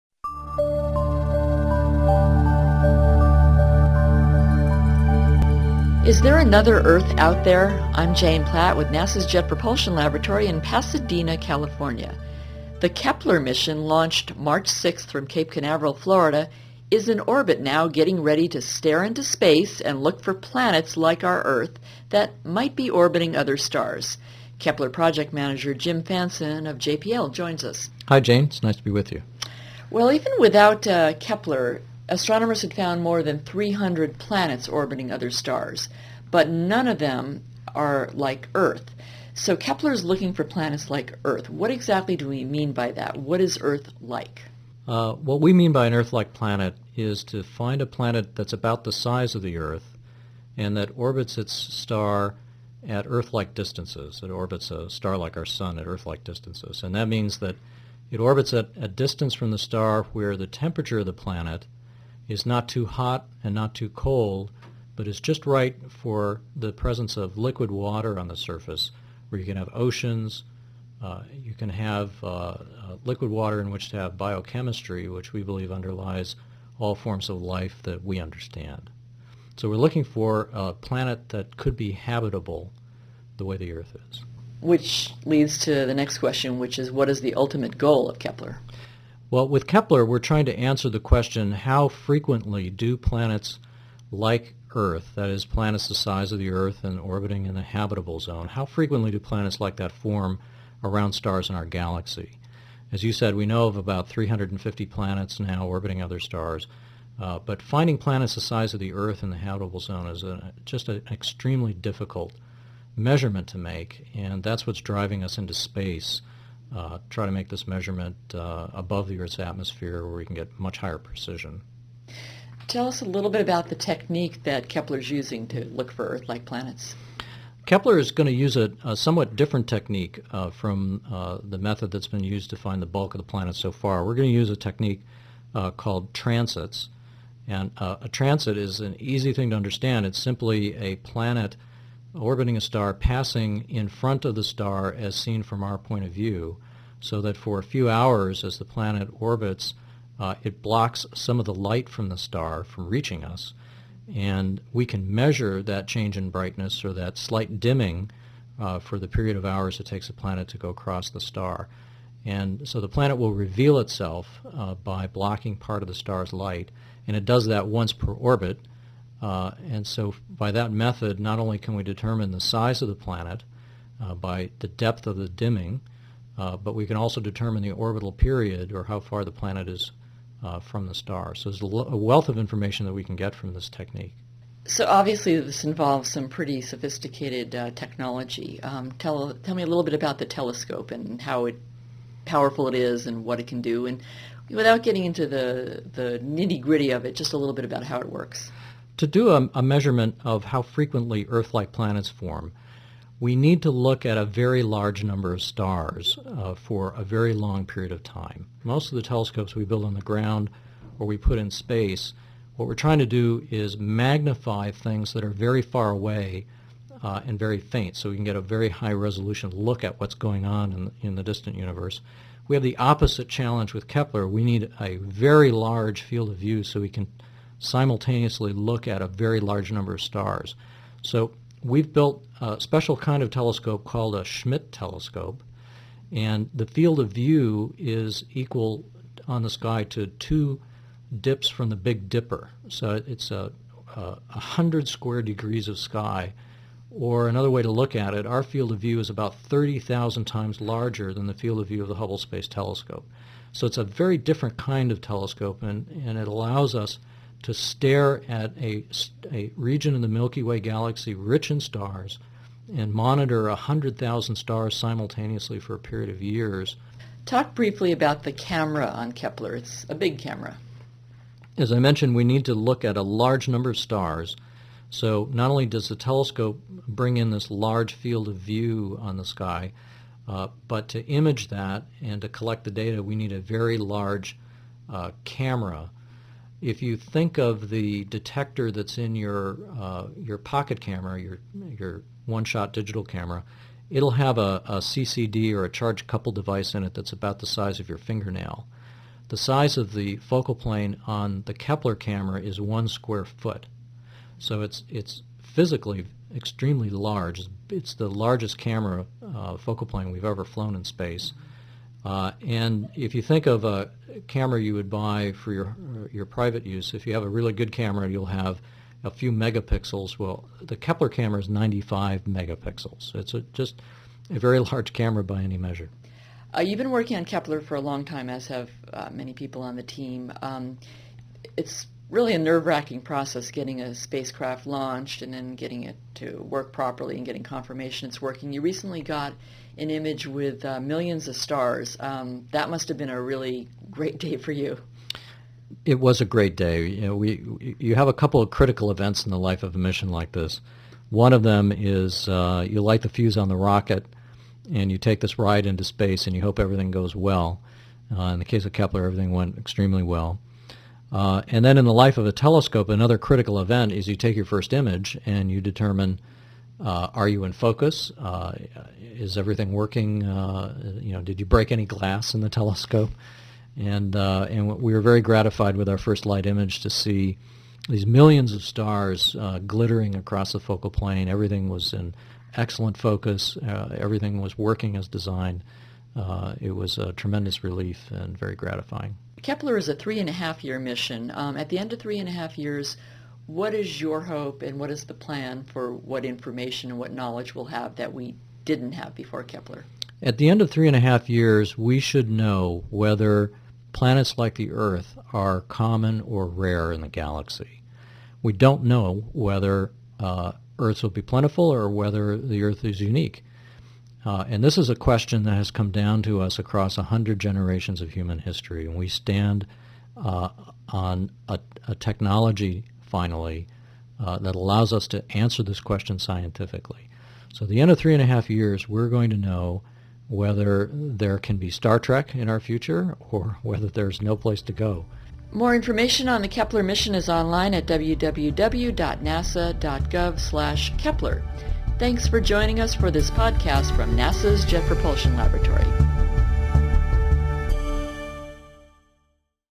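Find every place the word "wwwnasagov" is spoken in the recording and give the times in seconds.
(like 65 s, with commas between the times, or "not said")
437 s.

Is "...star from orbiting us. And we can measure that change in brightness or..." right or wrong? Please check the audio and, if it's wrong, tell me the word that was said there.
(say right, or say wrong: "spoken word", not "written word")
wrong: "reaching", not "orbiting".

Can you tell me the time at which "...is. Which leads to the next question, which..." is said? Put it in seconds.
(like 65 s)
84 s.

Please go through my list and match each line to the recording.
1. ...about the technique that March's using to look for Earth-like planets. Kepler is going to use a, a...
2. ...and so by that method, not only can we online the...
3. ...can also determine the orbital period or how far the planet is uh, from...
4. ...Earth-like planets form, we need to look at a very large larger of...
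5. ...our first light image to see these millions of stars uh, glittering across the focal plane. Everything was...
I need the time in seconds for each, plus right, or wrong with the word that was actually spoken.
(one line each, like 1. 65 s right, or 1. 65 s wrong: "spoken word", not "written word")
1. 123 s wrong: "Kepler", not "March"
2. 169 s wrong: "determine", not "online"
3. 176 s right
4. 201 s wrong: "number", not "larger"
5. 375 s right.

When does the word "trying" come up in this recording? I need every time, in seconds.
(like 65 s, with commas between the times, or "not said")
90 s, 212 s.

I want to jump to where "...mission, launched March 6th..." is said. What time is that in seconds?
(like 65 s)
13 s.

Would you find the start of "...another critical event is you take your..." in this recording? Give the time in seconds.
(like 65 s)
362 s.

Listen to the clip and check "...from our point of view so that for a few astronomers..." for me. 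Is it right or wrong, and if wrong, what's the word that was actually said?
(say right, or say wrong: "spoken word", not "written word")
wrong: "hours", not "astronomers".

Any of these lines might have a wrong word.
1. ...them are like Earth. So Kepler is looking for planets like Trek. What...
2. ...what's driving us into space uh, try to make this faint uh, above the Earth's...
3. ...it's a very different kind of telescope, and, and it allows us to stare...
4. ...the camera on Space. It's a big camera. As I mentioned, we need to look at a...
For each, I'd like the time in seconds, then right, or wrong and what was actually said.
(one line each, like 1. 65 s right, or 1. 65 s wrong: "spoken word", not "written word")
1. 36 s wrong: "Earth", not "Trek"
2. 114 s wrong: "measurement", not "faint"
3. 253 s right
4. 268 s wrong: "Kepler", not "Space".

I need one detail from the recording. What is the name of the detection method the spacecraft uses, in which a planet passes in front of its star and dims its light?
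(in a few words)
transits.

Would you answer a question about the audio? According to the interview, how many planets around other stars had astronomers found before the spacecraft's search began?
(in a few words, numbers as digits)
more than 300.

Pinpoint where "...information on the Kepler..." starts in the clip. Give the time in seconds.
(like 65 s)
435 s.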